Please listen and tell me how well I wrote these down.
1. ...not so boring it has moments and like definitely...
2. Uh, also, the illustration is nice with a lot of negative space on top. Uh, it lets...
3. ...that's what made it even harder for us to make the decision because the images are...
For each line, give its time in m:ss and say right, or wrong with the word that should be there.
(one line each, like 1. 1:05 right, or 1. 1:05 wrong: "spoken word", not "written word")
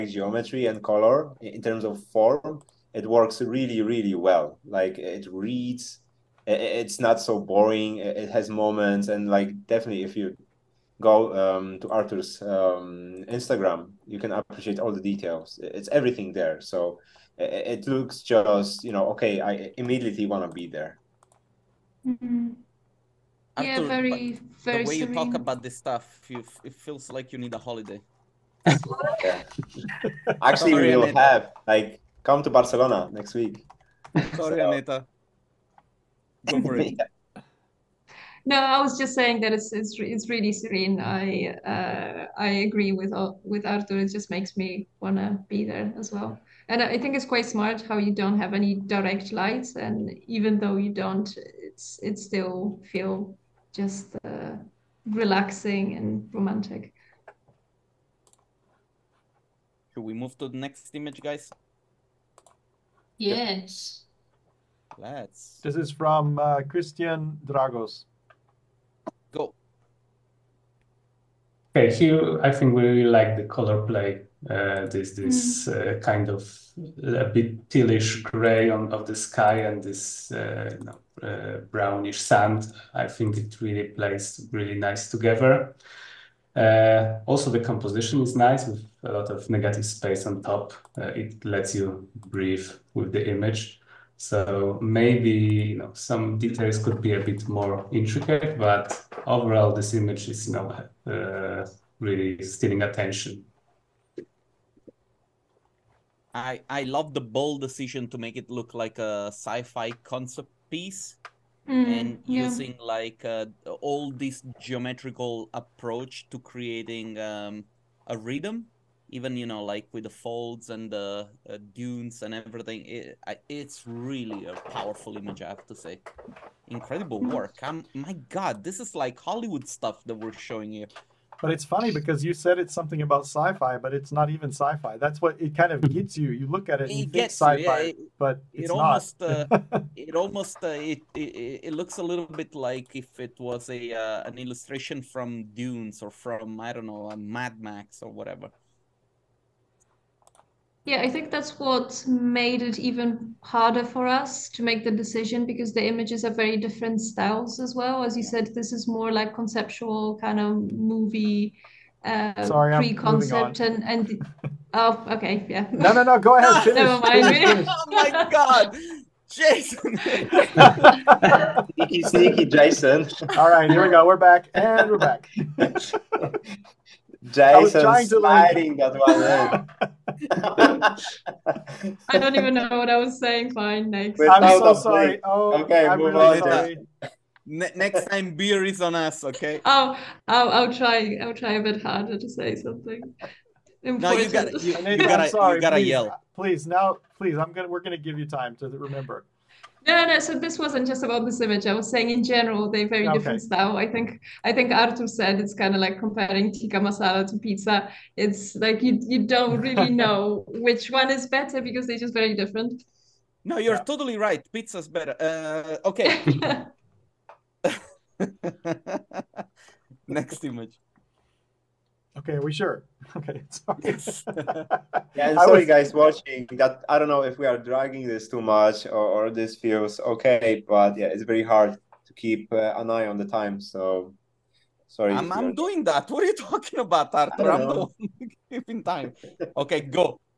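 1. 0:06 right
2. 1:26 wrong: "composition", not "illustration"
3. 2:31 right.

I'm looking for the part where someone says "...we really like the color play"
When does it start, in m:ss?
1:12.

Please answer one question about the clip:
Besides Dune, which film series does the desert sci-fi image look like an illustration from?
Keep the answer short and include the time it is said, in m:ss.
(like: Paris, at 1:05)
Mad Max, at 2:27.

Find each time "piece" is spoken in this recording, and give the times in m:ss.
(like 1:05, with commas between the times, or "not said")
1:50.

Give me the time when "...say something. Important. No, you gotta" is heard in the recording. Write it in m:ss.
3:12.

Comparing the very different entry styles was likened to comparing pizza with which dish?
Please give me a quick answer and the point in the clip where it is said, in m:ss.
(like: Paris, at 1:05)
Tikka masala, at 3:26.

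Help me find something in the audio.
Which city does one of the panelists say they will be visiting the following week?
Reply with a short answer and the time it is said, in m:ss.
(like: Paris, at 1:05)
Barcelona, at 0:32.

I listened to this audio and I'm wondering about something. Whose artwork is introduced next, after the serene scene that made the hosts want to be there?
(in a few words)
Christian Dragos.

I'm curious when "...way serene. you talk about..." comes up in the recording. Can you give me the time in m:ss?
0:24.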